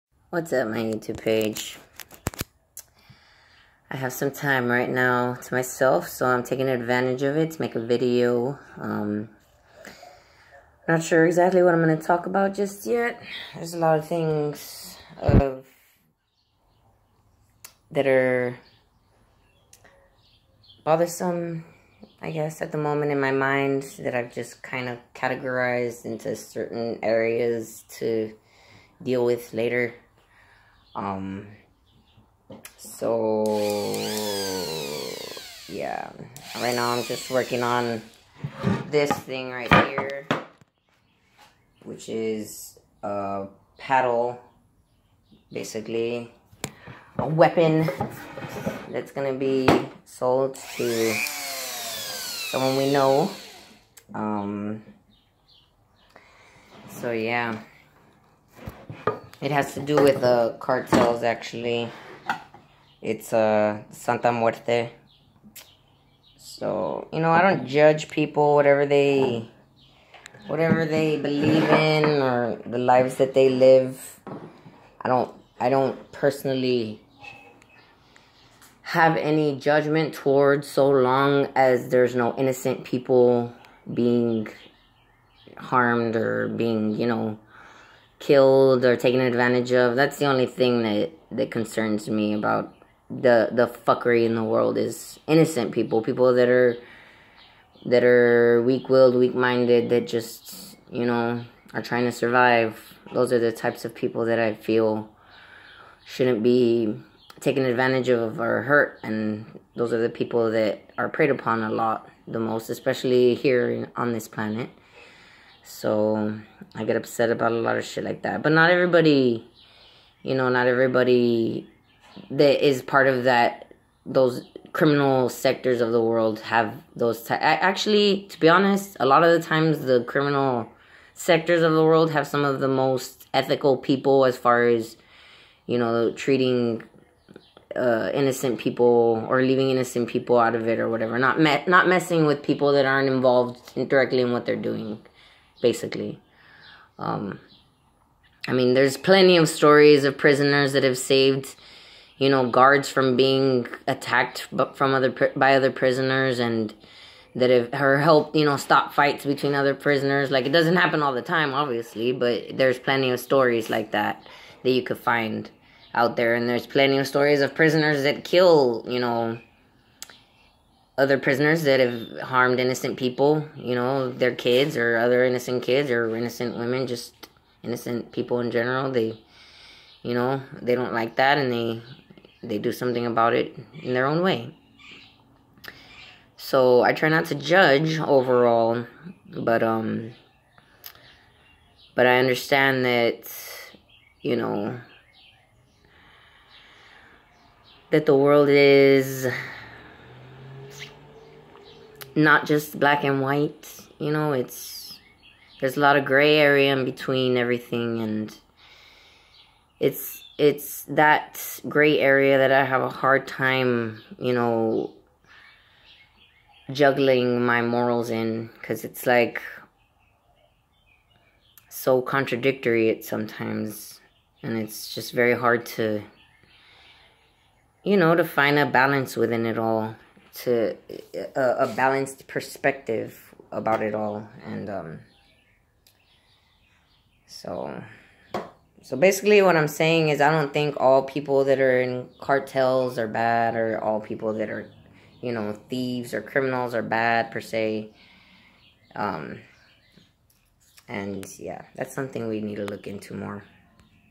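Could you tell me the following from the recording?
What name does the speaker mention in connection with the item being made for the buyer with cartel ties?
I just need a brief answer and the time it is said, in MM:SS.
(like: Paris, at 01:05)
Santa Muerte, at 01:03.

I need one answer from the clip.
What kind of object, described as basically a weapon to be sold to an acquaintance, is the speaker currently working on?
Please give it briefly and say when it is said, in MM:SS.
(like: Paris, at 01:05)
A paddle, at 00:43.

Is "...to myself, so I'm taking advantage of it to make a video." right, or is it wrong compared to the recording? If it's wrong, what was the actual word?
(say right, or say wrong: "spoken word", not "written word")
right.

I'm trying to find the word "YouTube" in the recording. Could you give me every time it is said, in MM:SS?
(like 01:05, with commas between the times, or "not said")
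00:00.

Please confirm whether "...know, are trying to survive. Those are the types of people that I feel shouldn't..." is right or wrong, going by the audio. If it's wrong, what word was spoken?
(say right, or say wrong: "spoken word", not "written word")
right.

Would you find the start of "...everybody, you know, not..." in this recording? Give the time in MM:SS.
01:58.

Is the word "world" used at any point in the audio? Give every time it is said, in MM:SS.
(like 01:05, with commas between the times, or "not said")
01:34, 02:06, 02:11, 03:18.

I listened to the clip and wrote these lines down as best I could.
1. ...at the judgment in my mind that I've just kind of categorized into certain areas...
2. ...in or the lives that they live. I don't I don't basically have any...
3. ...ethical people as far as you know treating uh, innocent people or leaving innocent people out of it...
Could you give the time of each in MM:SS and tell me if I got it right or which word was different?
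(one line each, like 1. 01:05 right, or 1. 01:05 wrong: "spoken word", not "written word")
1. 00:22 wrong: "moment", not "judgment"
2. 01:11 wrong: "personally", not "basically"
3. 02:13 right.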